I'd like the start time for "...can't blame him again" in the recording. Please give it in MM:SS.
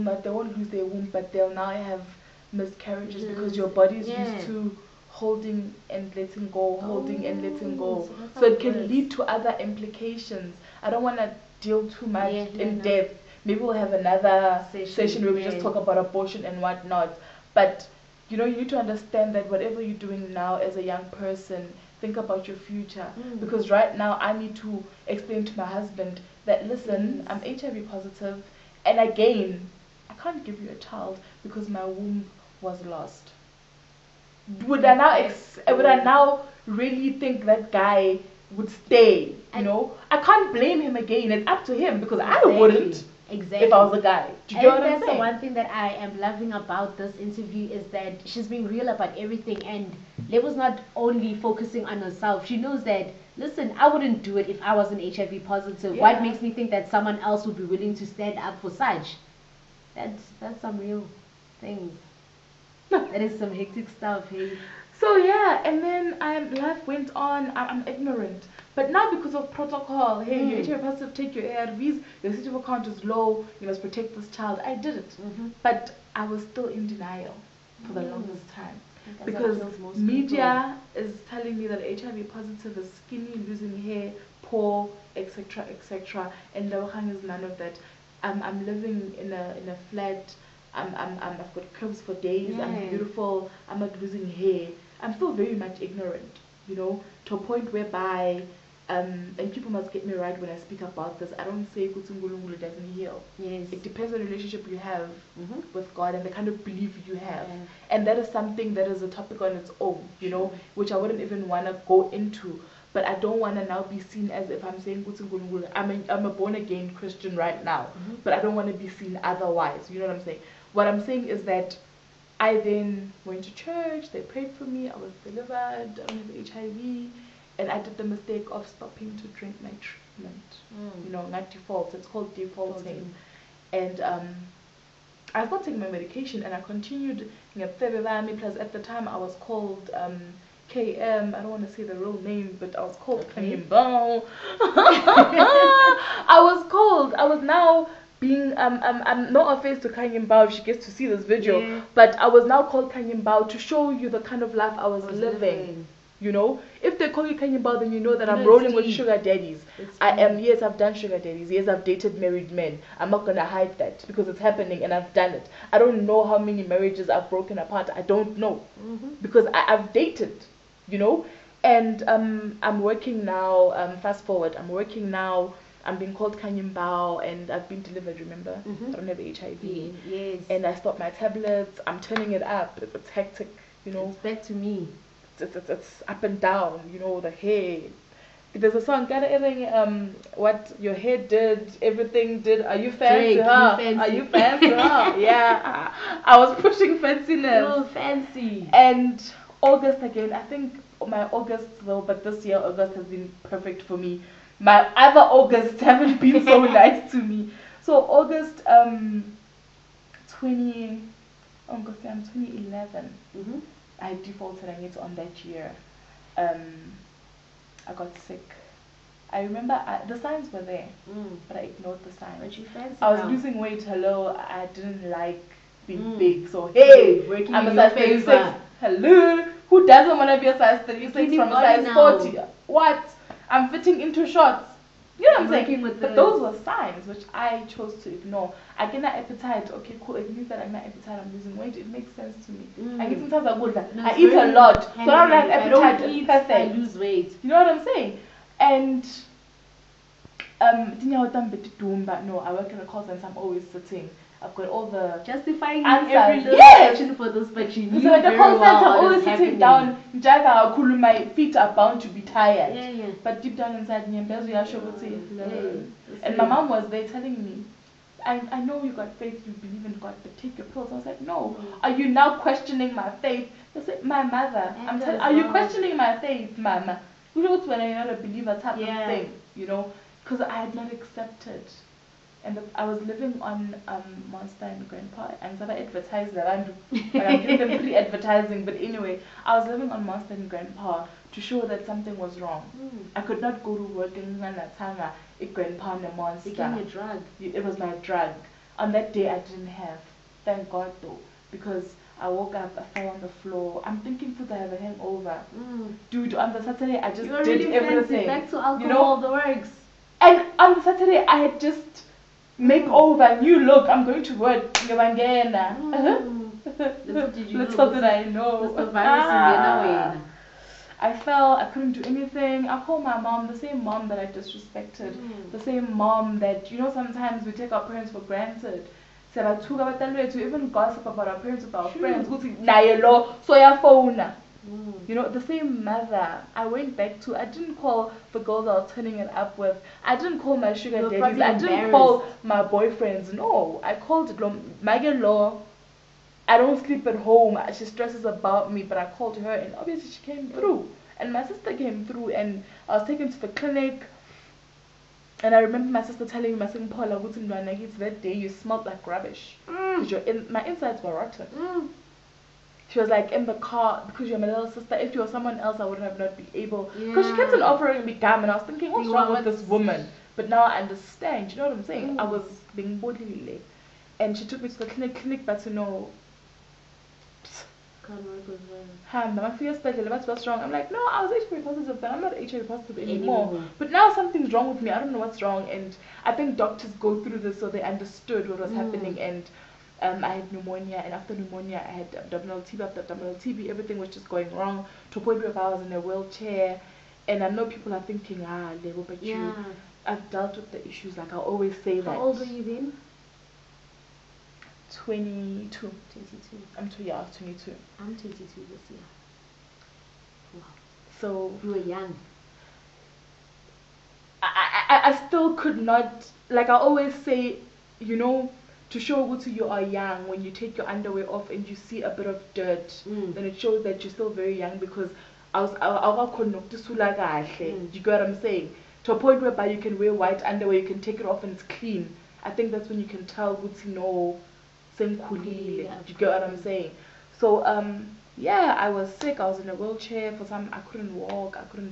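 00:40.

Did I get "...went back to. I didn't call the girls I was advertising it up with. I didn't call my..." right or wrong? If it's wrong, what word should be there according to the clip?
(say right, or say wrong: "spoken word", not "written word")
wrong: "turning", not "advertising".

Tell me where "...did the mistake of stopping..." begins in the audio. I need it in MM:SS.
02:07.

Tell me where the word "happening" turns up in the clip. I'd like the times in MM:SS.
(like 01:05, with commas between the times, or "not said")
02:44, 06:28.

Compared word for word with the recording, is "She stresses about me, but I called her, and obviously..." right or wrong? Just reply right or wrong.
right.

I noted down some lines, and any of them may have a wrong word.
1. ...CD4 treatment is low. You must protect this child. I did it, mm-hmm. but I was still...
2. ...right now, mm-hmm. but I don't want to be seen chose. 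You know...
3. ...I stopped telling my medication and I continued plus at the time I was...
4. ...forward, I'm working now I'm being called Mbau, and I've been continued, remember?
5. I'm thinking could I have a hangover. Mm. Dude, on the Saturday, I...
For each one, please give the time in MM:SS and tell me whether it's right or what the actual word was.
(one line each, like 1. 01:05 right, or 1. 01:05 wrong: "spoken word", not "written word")
1. 01:12 wrong: "count", not "treatment"
2. 01:57 wrong: "otherwise", not "chose"
3. 02:15 wrong: "taking", not "telling"
4. 02:54 wrong: "delivered", not "continued"
5. 05:03 right.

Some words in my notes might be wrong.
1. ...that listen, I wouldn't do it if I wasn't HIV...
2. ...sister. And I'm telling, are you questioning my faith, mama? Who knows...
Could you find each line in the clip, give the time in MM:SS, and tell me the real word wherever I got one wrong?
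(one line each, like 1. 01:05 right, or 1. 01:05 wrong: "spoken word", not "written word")
1. 00:52 right
2. 04:34 wrong: "mother", not "sister".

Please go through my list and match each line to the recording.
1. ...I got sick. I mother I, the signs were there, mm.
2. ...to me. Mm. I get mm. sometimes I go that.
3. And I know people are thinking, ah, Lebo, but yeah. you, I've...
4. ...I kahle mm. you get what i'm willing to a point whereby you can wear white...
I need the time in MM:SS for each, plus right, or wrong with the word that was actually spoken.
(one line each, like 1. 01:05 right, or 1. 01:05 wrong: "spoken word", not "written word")
1. 03:37 wrong: "remember", not "mother"
2. 04:02 right
3. 06:37 right
4. 07:07 wrong: "saying", not "willing".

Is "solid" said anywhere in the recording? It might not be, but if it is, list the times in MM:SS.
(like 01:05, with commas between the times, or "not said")
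not said.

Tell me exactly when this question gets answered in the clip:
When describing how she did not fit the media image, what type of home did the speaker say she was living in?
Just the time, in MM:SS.
01:29.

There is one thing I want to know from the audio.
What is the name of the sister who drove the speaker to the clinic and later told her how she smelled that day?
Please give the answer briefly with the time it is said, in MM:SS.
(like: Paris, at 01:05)
Paula, at 05:56.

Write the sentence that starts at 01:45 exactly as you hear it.
with God and the kind of belief you have.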